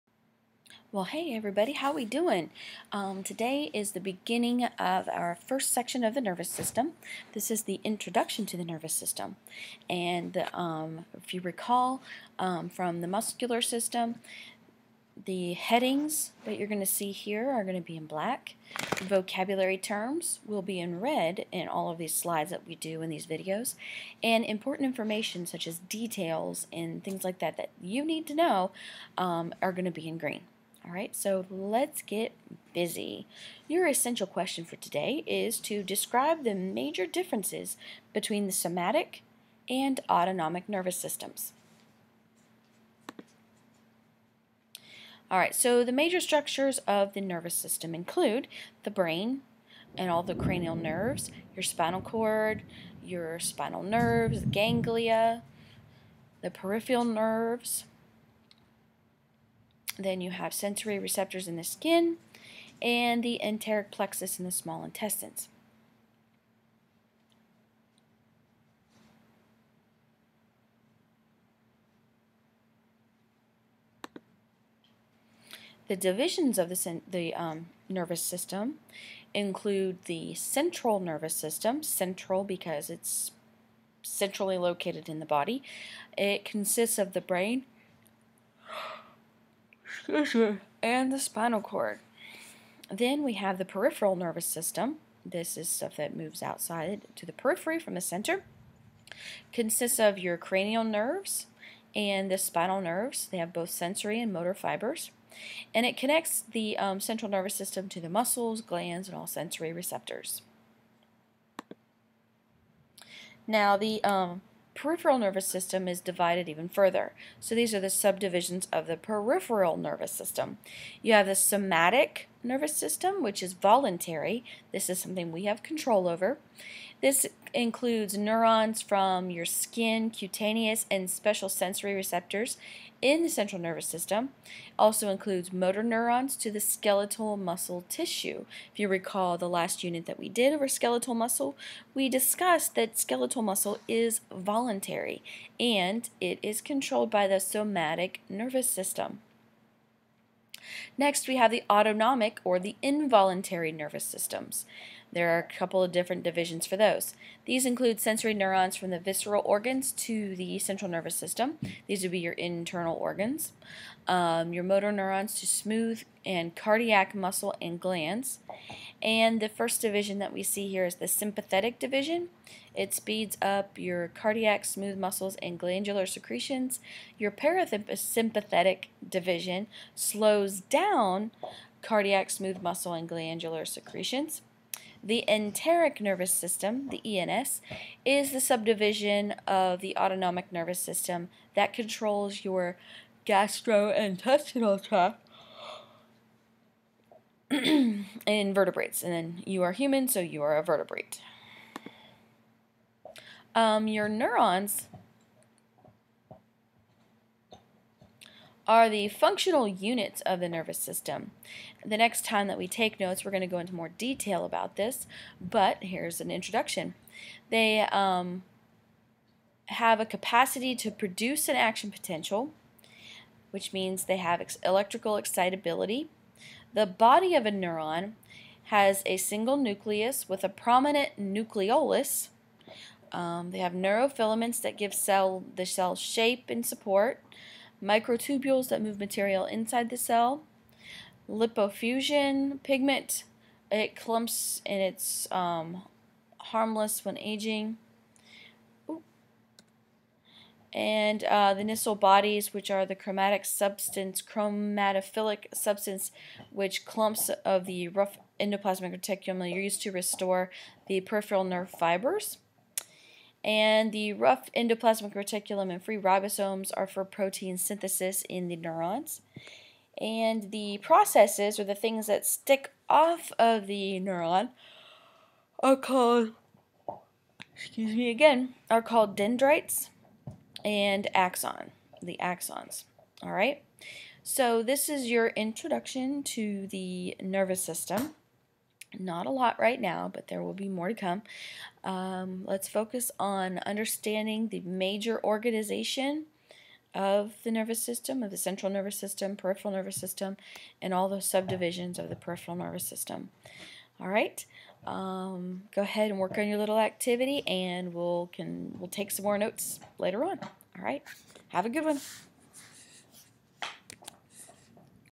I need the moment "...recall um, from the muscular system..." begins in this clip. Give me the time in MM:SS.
00:11.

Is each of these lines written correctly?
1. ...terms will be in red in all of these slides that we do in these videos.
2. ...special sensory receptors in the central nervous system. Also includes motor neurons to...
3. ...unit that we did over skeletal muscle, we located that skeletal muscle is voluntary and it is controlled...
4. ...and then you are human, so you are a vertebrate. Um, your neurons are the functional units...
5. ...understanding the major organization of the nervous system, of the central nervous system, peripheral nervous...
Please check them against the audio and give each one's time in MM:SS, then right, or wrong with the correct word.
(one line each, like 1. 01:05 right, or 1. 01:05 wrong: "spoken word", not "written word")
1. 00:19 right
2. 02:11 right
3. 02:19 wrong: "discussed", not "located"
4. 03:19 right
5. 04:53 right.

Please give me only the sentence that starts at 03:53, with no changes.
Um, they have neurofilaments that give cell the cell shape and support, microtubules that move material inside the cell, lipofuscin pigment.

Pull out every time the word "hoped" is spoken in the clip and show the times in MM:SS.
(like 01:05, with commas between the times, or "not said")
not said.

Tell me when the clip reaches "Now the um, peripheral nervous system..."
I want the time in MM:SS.
01:53.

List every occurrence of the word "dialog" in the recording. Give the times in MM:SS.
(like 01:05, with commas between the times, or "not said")
not said.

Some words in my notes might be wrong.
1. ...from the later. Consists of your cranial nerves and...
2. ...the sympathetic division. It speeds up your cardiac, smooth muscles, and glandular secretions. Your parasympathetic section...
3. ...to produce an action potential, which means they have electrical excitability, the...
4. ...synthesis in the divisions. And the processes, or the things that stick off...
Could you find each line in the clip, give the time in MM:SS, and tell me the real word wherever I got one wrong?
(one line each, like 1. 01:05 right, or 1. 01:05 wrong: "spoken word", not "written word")
1. 01:37 wrong: "center", not "later"
2. 02:50 wrong: "division", not "section"
3. 03:40 right
4. 04:27 wrong: "neurons", not "divisions".